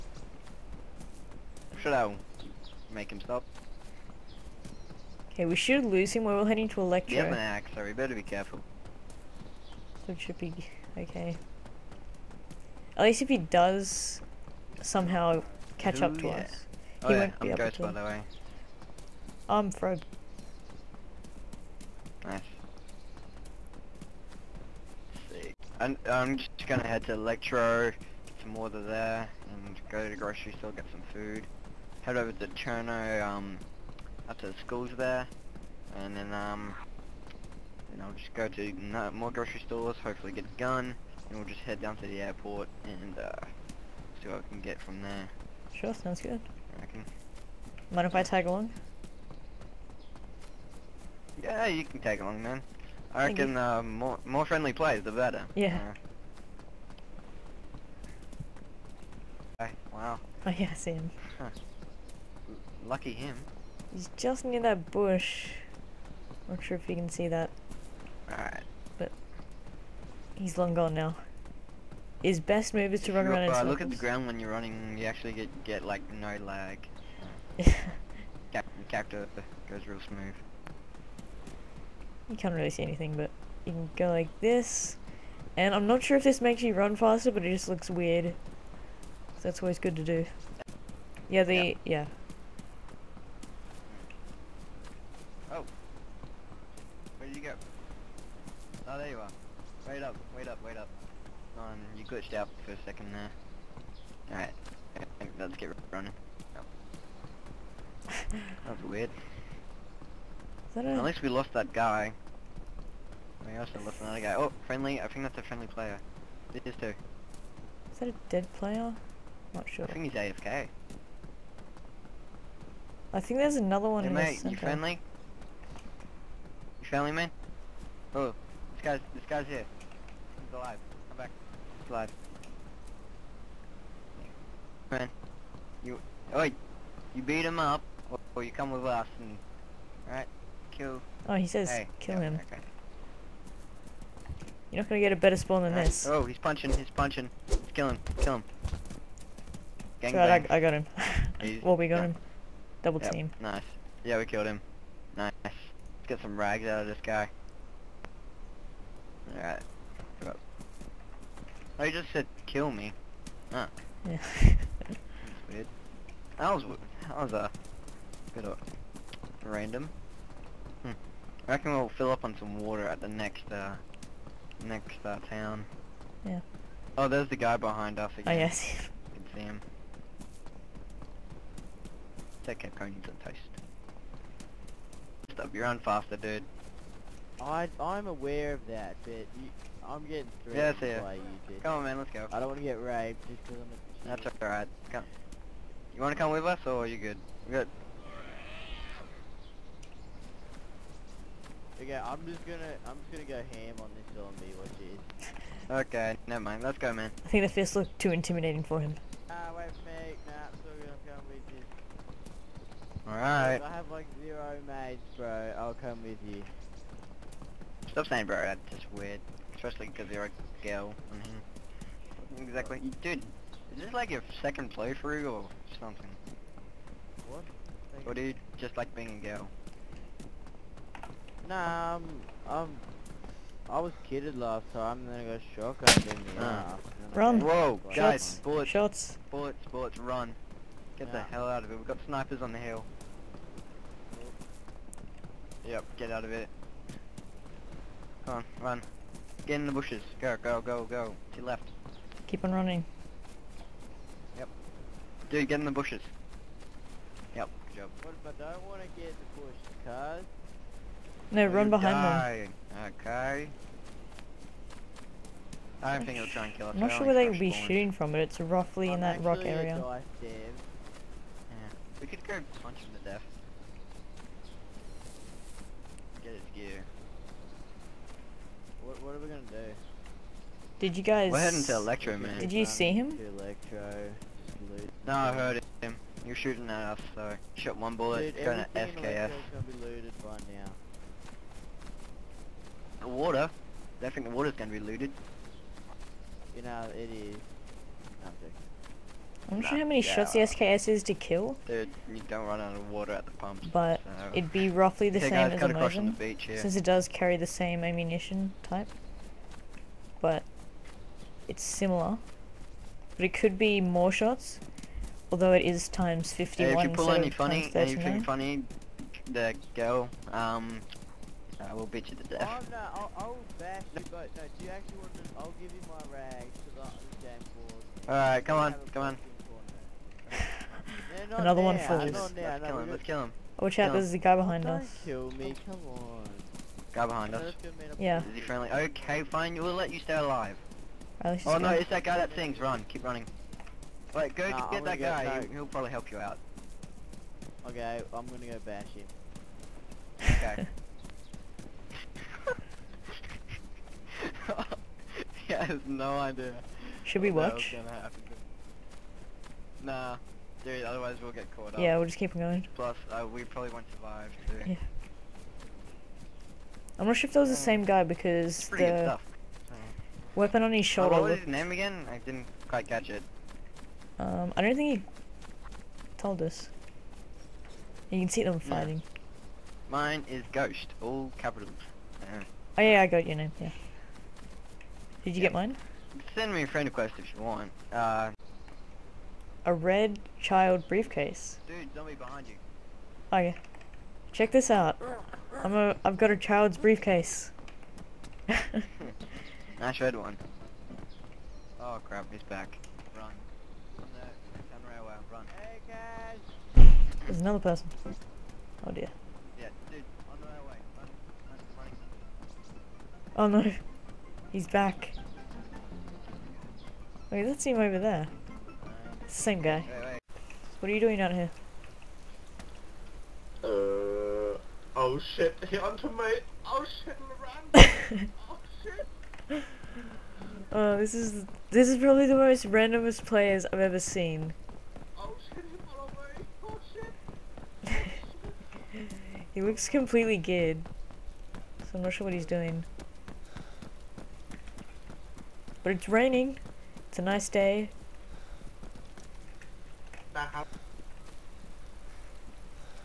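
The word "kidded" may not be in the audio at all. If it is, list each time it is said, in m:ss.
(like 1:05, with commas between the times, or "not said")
3:54.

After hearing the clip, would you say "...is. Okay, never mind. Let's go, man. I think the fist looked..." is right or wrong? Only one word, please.
right.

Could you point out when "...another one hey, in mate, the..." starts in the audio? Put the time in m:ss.
2:03.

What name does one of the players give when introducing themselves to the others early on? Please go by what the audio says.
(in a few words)
Fred.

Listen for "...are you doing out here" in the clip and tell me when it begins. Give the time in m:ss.
7:00.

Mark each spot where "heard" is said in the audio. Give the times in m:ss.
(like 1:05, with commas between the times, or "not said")
4:45.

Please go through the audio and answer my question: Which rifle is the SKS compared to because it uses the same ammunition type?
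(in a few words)
Mosin.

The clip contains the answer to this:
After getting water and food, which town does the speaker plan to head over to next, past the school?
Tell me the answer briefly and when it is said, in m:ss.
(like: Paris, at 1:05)
Cherno, at 0:32.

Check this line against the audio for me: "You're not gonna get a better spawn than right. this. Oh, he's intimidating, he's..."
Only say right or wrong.
wrong.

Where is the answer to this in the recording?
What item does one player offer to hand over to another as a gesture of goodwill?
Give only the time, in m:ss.
5:26.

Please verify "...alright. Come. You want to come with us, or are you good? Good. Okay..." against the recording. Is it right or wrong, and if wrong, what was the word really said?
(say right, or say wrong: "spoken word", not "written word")
right.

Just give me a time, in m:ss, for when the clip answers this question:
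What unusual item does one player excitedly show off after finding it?
6:29.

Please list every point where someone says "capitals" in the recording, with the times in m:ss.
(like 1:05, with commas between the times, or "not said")
6:21.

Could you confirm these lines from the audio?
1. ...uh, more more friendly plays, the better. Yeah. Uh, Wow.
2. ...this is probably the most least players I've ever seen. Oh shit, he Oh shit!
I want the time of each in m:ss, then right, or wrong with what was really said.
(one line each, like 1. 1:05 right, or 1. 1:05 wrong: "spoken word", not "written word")
1. 0:53 right
2. 7:11 wrong: "randomest", not "least".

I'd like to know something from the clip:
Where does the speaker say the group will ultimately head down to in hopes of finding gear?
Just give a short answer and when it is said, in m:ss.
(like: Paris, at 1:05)
the airport, at 0:42.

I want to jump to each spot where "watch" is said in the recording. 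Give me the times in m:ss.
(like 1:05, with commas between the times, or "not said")
5:33, 5:57.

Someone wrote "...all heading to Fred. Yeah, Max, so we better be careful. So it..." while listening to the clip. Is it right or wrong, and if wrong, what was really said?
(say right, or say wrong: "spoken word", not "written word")
wrong: "Electro", not "Fred".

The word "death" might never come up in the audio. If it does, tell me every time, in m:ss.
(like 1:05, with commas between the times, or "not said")
4:33, 5:22.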